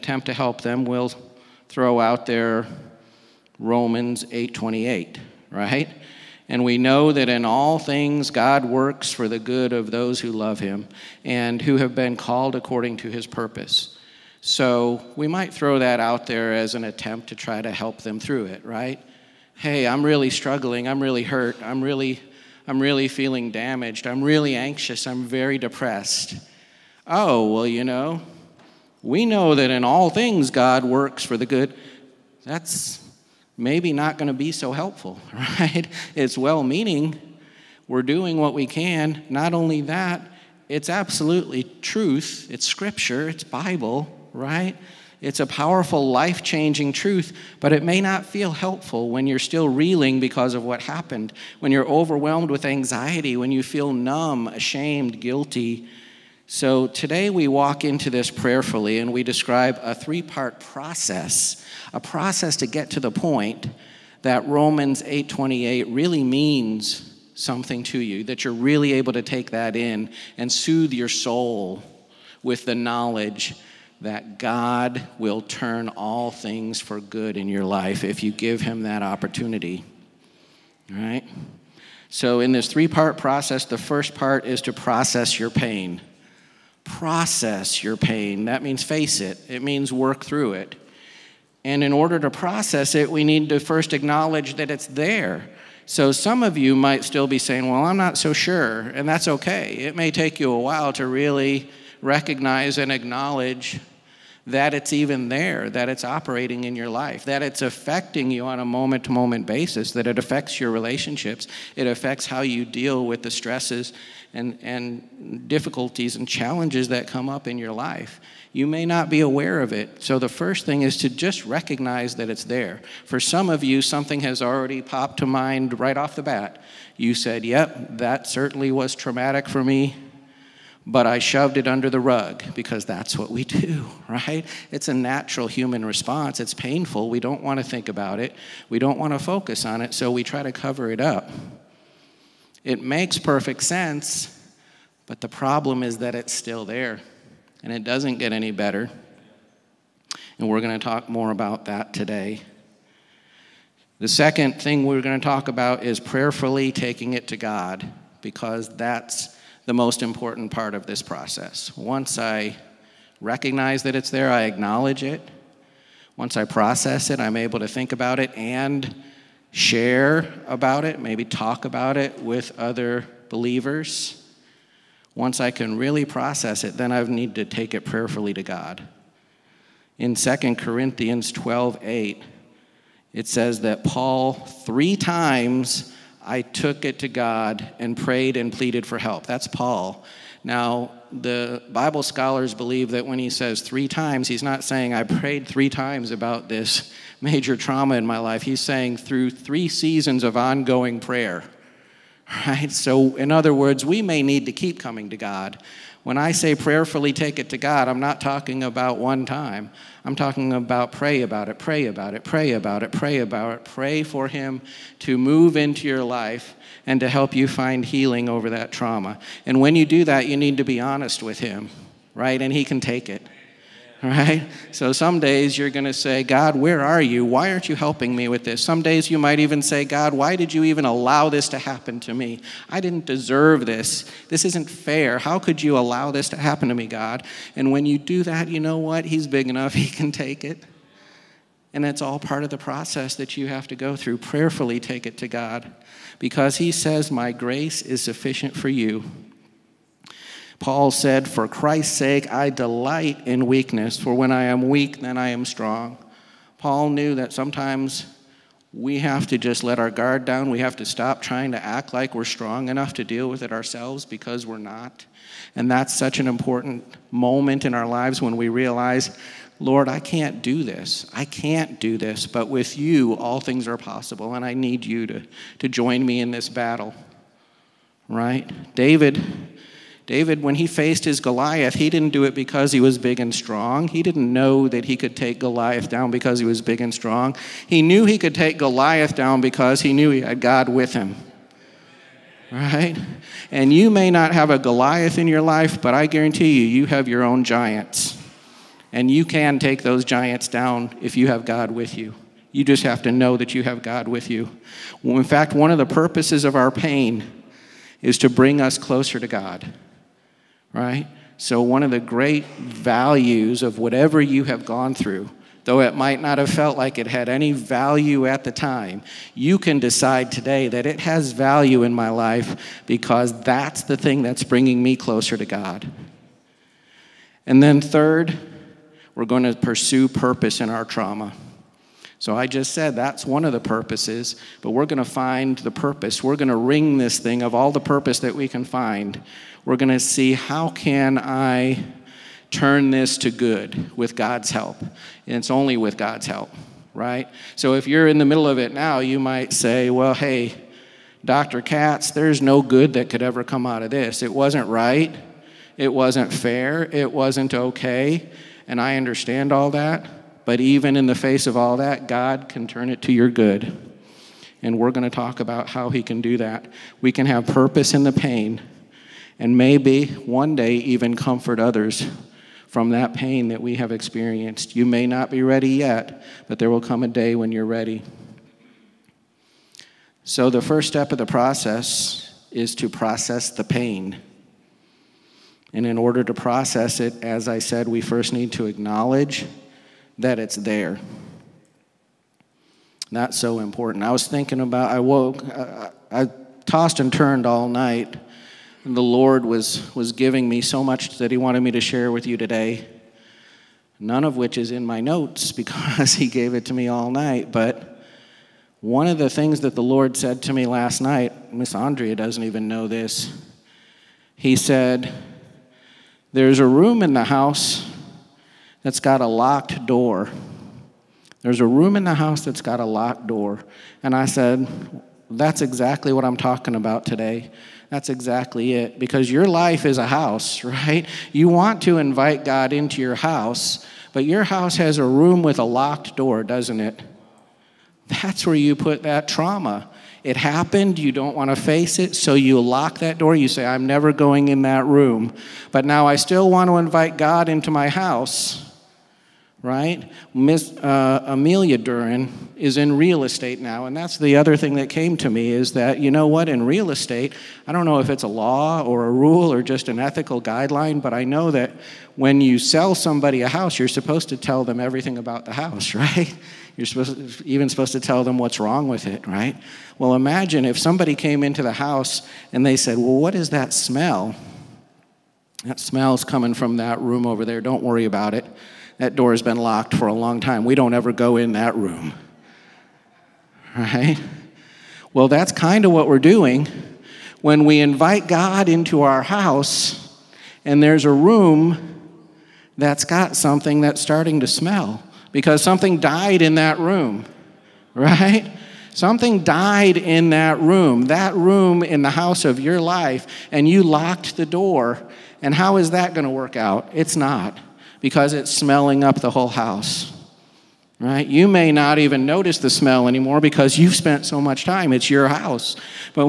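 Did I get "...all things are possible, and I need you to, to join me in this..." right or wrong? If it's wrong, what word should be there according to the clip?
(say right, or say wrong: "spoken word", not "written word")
right.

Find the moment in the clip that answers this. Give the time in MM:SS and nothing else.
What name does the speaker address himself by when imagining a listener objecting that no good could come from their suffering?
05:51.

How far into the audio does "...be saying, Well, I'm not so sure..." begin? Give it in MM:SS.
01:37.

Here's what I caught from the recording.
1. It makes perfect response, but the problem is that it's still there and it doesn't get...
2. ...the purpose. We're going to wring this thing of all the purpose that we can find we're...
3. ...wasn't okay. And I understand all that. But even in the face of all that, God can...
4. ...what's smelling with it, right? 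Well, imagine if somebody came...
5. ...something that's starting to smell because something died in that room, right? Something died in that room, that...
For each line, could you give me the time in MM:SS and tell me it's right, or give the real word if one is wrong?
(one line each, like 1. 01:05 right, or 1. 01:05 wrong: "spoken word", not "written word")
1. 02:22 wrong: "sense", not "response"
2. 05:35 right
3. 05:57 right
4. 07:48 wrong: "wrong", not "smelling"
5. 08:13 right.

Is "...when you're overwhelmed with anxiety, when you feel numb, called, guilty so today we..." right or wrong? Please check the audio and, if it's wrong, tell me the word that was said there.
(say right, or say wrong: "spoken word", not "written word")
wrong: "ashamed", not "called".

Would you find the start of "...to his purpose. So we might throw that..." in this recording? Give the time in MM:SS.
00:12.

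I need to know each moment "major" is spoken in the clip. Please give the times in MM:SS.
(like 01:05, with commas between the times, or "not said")
03:17.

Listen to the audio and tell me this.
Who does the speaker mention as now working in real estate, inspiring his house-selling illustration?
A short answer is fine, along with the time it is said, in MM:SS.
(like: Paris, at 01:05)
Amelia Duren, at 07:31.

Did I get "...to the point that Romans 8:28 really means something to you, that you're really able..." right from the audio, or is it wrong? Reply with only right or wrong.
right.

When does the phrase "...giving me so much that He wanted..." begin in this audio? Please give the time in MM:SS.
06:40.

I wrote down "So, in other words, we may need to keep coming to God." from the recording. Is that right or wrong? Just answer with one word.
right.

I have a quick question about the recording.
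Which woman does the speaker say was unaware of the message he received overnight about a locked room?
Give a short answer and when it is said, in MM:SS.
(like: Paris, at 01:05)
Miss Andrea, at 06:51.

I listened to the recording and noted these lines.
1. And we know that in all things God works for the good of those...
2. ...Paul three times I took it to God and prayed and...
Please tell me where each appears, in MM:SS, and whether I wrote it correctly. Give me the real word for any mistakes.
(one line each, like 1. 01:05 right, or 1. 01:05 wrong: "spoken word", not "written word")
1. 00:06 right
2. 03:03 right.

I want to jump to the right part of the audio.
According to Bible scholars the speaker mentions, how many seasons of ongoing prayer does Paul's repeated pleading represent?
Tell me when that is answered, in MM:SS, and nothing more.
03:19.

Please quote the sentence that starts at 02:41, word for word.
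Once I recognize that it's there, I acknowledge it.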